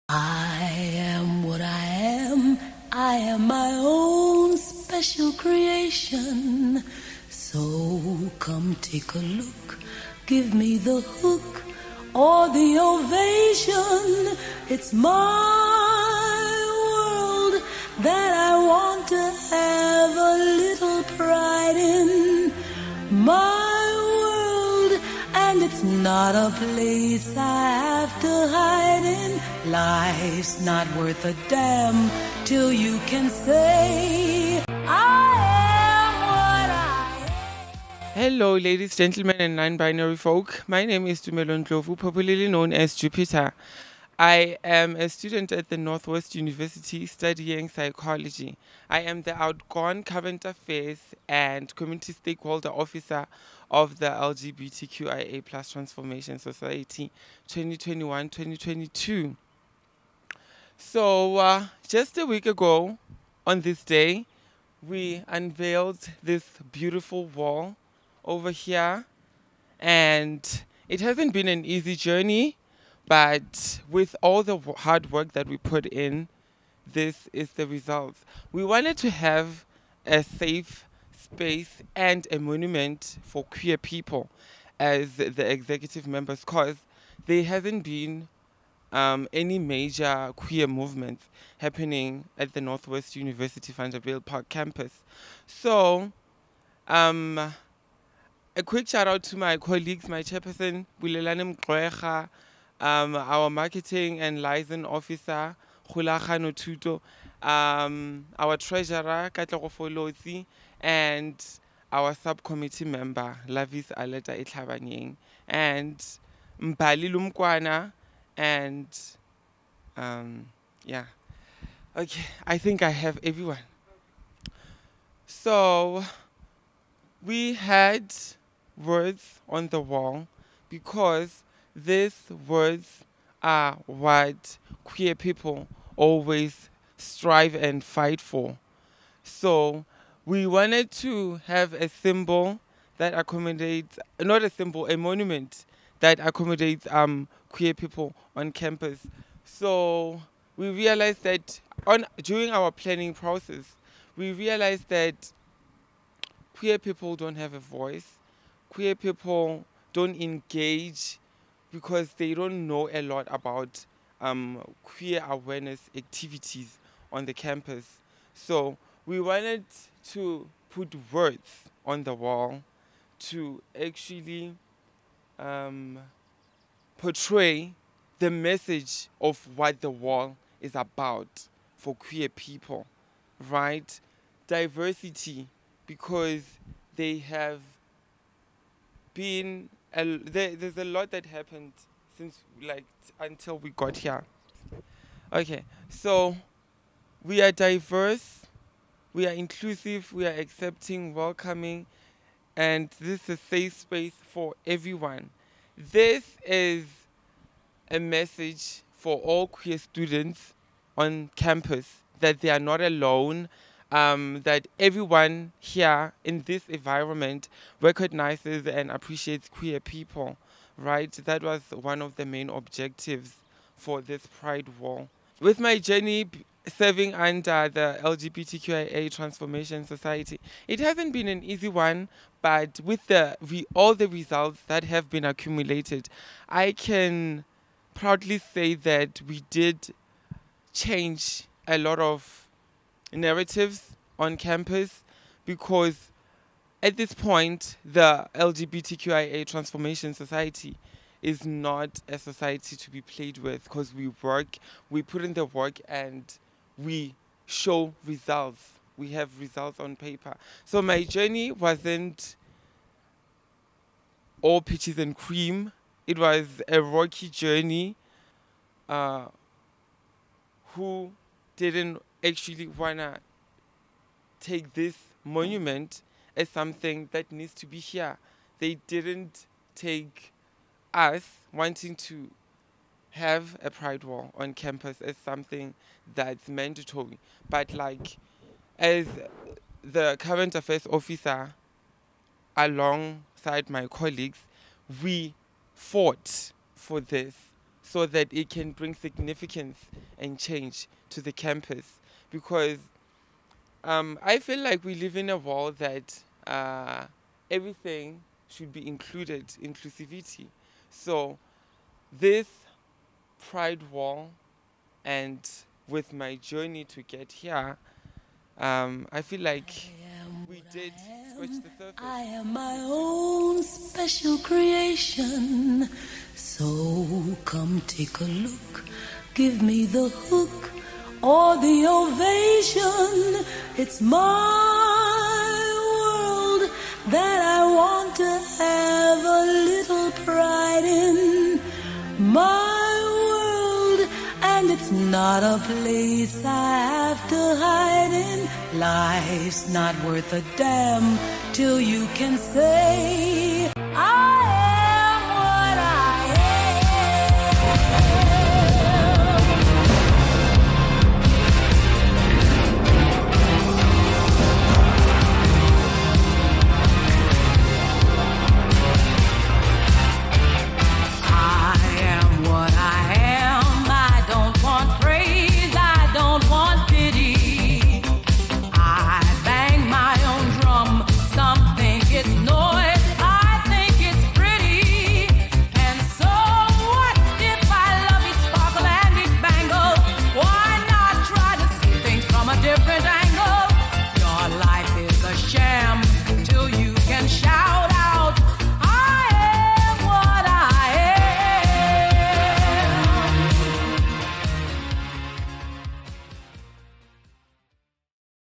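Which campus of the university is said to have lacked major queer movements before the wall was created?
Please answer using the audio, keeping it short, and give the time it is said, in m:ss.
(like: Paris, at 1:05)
Vanderbijlpark, at 1:33.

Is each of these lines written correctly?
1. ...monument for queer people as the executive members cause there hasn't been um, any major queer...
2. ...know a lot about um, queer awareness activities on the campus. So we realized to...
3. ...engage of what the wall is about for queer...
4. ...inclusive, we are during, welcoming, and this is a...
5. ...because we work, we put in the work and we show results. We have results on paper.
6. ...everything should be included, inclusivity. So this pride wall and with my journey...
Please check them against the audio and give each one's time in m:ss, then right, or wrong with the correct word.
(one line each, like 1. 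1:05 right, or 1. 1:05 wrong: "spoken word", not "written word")
1. 1:22 right
2. 2:42 wrong: "wanted", not "realized"
3. 2:58 wrong: "message", not "engage"
4. 3:19 wrong: "accepting", not "during"
5. 4:13 right
6. 5:07 right.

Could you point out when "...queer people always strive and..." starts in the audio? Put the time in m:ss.
2:14.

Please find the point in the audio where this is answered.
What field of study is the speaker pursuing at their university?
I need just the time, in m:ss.
0:47.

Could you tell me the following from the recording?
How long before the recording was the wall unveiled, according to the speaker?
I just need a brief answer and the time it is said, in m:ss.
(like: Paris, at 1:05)
A week ago, at 1:02.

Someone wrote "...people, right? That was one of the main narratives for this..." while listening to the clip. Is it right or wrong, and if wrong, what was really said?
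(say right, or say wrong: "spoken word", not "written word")
wrong: "objectives", not "narratives".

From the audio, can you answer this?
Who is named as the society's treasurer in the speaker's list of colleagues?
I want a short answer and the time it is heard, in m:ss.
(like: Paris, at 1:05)
Katlego Folozi, at 1:49.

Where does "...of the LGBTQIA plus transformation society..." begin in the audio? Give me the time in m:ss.
0:53.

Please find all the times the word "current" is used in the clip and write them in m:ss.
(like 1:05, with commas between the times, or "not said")
0:50, 4:50.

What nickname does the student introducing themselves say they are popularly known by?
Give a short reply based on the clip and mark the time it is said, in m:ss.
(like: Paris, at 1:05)
Jupiter, at 0:42.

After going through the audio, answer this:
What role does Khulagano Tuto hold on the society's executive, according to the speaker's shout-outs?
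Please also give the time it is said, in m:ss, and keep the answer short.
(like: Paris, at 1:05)
Marketing and liaison officer, at 1:43.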